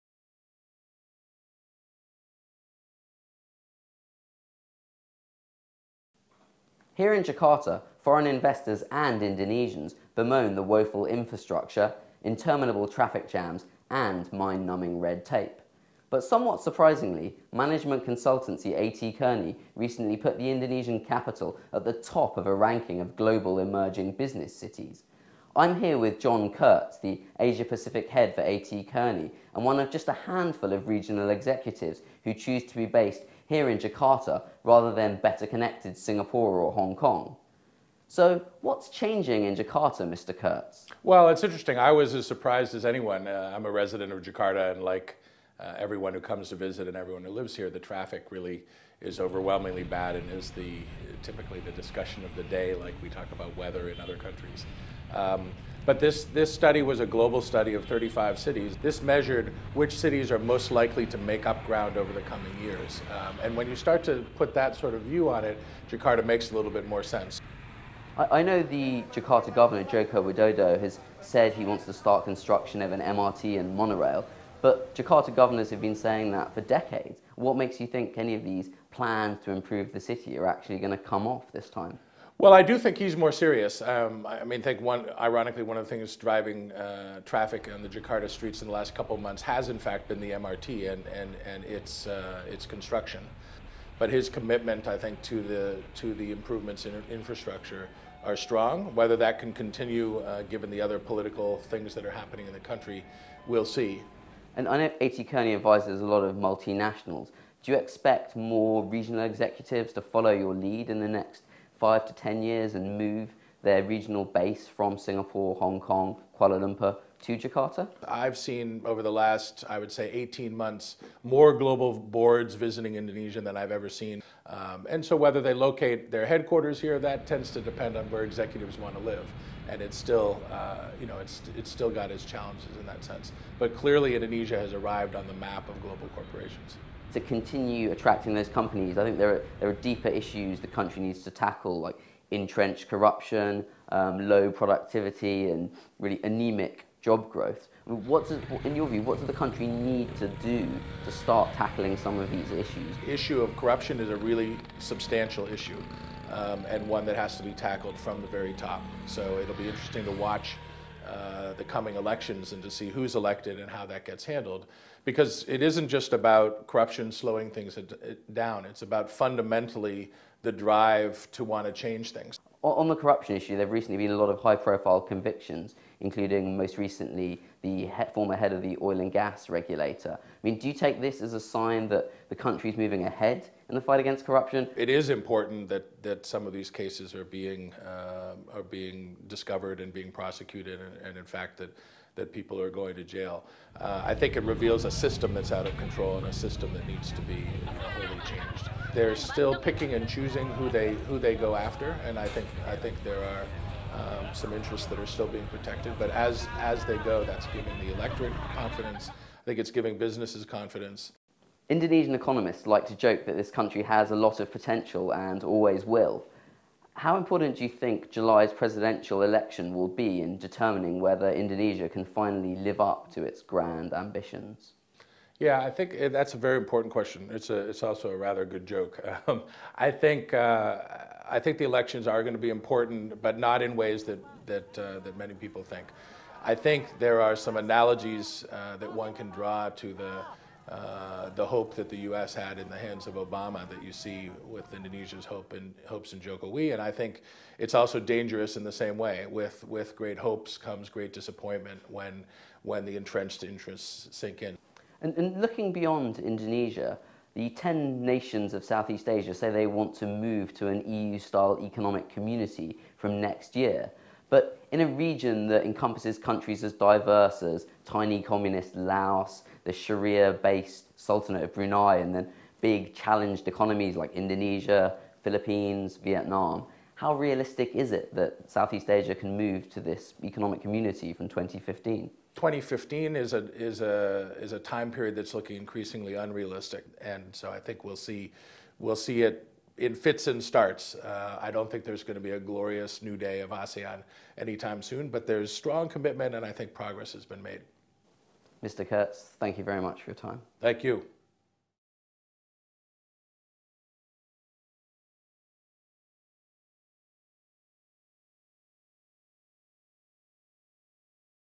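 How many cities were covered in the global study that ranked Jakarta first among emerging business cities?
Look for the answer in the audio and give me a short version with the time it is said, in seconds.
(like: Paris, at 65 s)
35, at 57 s.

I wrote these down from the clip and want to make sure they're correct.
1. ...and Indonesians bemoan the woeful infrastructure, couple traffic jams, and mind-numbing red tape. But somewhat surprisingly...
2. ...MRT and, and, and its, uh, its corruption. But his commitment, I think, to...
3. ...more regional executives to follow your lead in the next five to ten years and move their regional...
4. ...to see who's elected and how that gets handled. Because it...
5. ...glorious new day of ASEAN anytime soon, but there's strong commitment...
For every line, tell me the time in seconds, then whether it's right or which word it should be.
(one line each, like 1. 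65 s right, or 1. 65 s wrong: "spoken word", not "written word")
1. 8 s wrong: "interminable", not "couple"
2. 90 s wrong: "construction", not "corruption"
3. 108 s right
4. 162 s right
5. 292 s right.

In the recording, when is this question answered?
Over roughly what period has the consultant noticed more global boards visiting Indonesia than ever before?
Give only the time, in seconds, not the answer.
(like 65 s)
120 s.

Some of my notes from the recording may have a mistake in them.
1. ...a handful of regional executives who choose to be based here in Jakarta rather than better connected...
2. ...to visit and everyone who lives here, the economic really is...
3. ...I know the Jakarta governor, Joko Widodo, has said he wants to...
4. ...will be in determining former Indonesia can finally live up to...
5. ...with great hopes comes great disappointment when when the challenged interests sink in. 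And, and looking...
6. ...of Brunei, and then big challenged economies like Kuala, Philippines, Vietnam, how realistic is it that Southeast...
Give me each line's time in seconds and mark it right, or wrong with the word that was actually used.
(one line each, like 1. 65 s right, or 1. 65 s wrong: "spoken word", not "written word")
1. 30 s right
2. 46 s wrong: "traffic", not "economic"
3. 68 s right
4. 219 s wrong: "whether", not "former"
5. 249 s wrong: "entrenched", not "challenged"
6. 271 s wrong: "Indonesia", not "Kuala".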